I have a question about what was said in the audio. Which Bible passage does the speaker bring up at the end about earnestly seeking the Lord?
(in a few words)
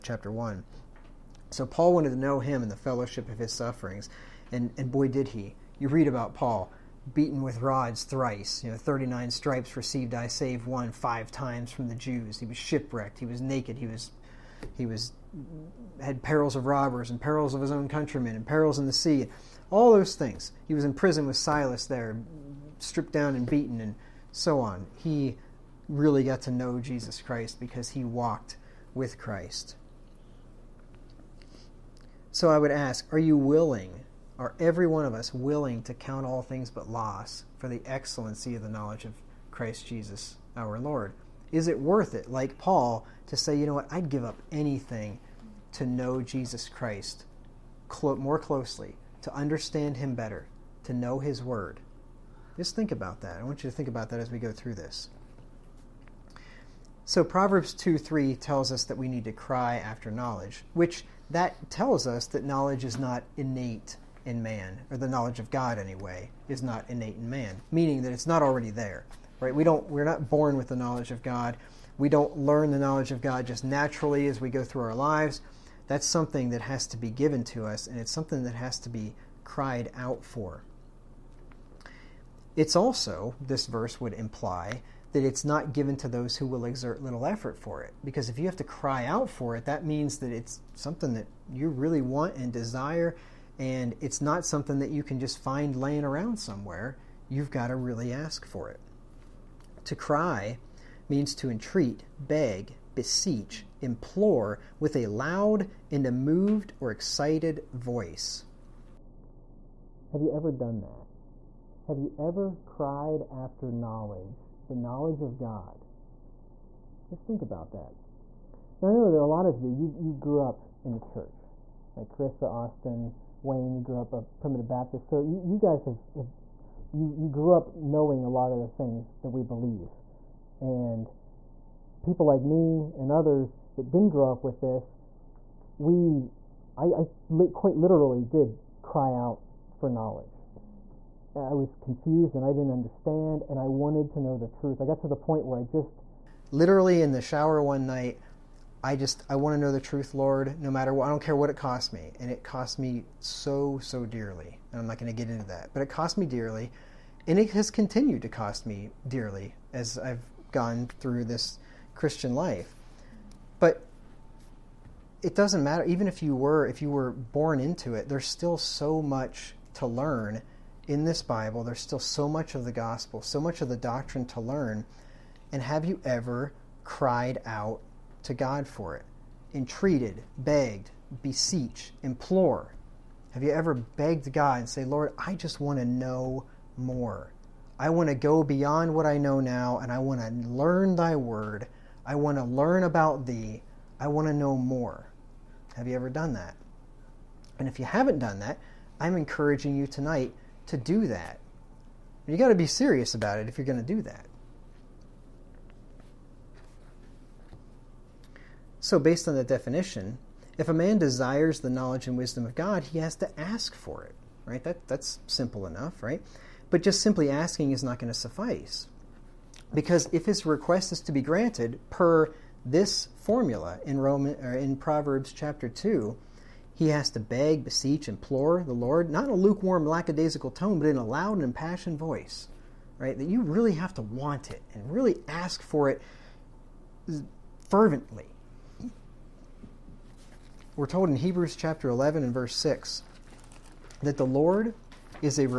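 Hebrews 11:6.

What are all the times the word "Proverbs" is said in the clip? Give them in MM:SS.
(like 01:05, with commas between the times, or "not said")
00:57, 03:44.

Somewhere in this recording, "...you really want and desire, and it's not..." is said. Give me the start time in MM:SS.
01:31.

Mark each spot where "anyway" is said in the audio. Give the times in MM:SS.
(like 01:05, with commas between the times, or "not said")
01:05.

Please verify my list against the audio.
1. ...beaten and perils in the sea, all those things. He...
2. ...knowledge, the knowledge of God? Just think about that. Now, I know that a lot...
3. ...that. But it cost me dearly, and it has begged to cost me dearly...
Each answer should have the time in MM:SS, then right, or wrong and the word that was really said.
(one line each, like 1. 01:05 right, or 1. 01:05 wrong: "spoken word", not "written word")
1. 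00:17 wrong: "countrymen", not "beaten"
2. 01:53 right
3. 02:35 wrong: "continued", not "begged".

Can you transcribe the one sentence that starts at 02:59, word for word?
Entreated, begged, beseech, implore, have you ever begged God and say, Lord, I just want to know more?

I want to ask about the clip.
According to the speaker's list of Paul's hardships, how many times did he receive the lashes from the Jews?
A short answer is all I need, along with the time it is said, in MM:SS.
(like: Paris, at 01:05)
5, at 00:10.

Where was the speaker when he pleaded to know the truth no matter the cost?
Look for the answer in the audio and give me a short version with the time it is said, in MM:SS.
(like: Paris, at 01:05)
In the shower, at 02:27.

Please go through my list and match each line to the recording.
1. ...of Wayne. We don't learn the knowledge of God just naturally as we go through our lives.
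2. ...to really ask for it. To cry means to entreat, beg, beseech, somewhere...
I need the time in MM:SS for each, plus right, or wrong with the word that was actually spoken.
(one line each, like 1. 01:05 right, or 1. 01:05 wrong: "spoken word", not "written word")
1. 01:11 wrong: "God", not "Wayne"
2. 01:37 wrong: "implore", not "somewhere".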